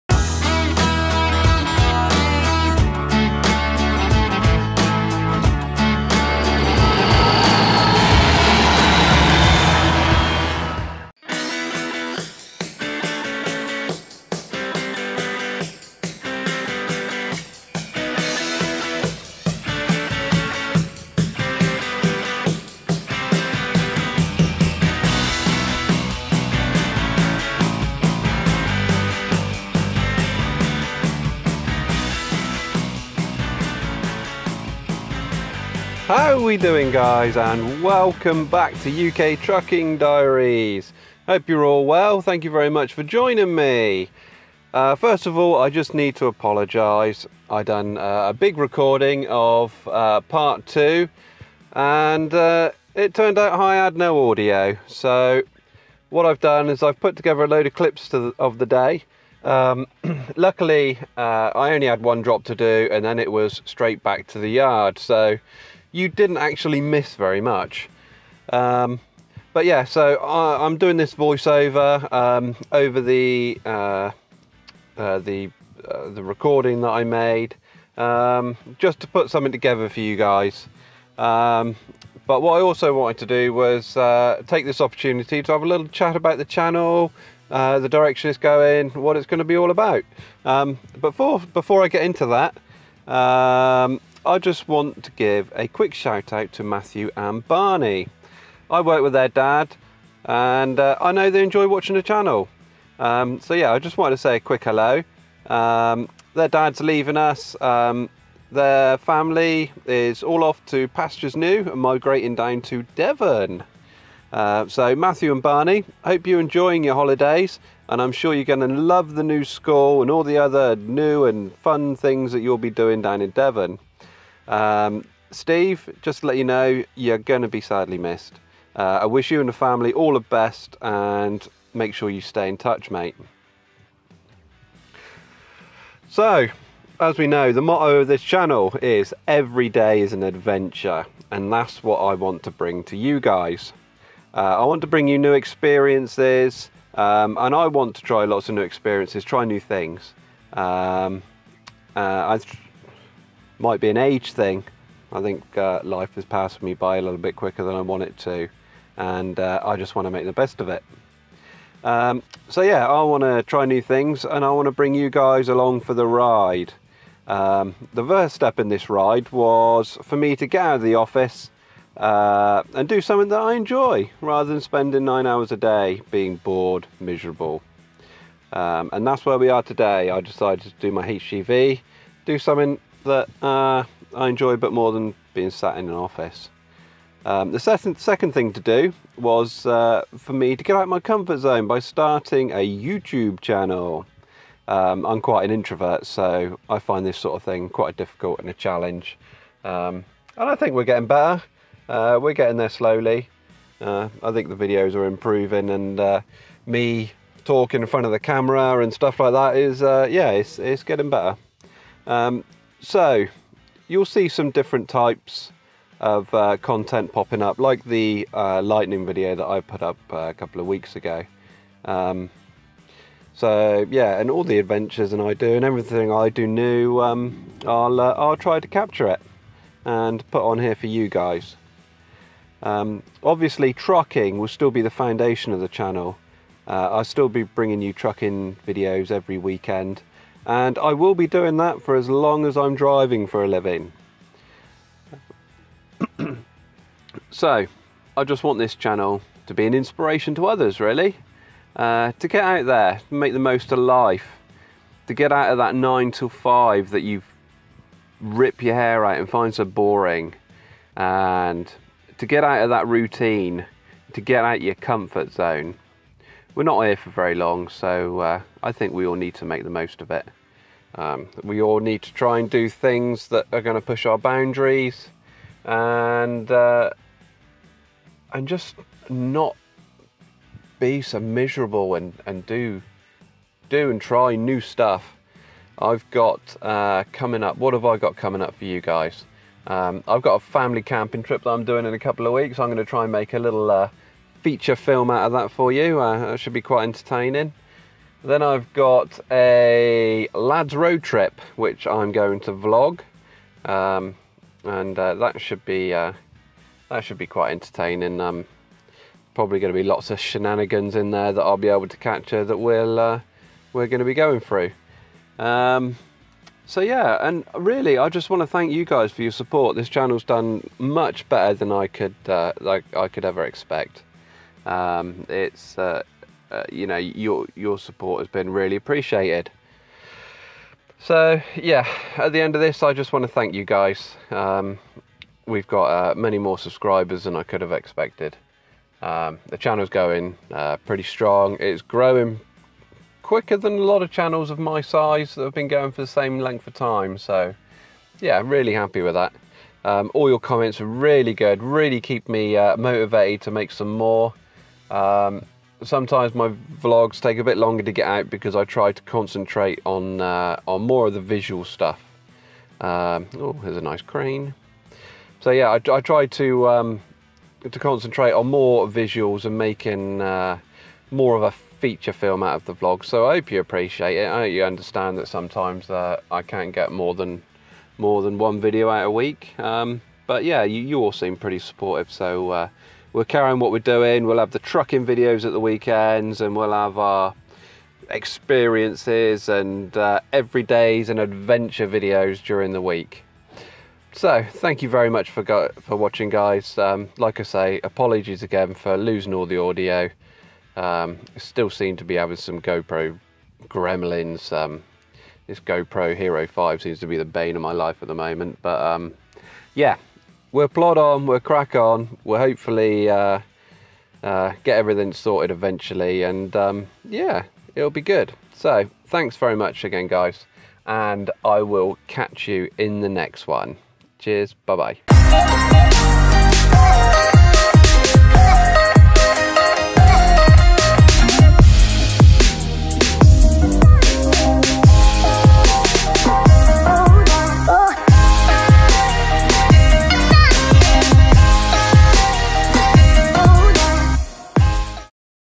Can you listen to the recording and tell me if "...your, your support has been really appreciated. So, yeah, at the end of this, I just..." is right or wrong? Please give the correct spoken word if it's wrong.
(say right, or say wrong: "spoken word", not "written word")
right.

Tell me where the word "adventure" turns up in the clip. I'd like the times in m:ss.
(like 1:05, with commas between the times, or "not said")
2:20, 3:44, 6:31.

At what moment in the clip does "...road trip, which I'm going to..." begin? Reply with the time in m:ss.
5:00.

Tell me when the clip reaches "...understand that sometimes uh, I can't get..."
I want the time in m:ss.
6:14.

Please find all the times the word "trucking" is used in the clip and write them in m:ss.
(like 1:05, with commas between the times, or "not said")
0:39, 3:53, 3:57, 6:24.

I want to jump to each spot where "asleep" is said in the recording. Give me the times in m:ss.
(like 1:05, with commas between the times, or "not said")
not said.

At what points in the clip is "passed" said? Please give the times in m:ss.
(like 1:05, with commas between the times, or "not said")
2:36.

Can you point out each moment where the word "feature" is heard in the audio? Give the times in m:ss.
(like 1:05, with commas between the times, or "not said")
4:54, 6:11.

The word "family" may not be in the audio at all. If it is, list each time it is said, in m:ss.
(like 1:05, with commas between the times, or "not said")
1:48, 2:09, 4:50.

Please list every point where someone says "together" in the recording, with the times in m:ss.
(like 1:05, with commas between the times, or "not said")
0:57, 1:19.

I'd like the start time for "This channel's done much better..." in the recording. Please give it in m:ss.
5:19.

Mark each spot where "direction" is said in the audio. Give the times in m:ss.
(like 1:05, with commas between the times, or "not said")
1:27.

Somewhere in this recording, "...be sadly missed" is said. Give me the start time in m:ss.
2:07.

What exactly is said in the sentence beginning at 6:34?
So thank you very much for for watching guys.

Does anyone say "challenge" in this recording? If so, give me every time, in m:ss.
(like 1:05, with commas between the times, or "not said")
3:18.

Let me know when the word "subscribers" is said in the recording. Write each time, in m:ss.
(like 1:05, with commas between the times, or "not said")
5:36.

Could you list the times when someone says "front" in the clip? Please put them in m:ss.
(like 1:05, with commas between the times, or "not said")
3:27.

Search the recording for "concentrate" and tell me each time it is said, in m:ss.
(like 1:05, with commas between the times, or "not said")
5:59, 6:07.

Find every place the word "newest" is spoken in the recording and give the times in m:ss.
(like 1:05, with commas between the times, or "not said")
not said.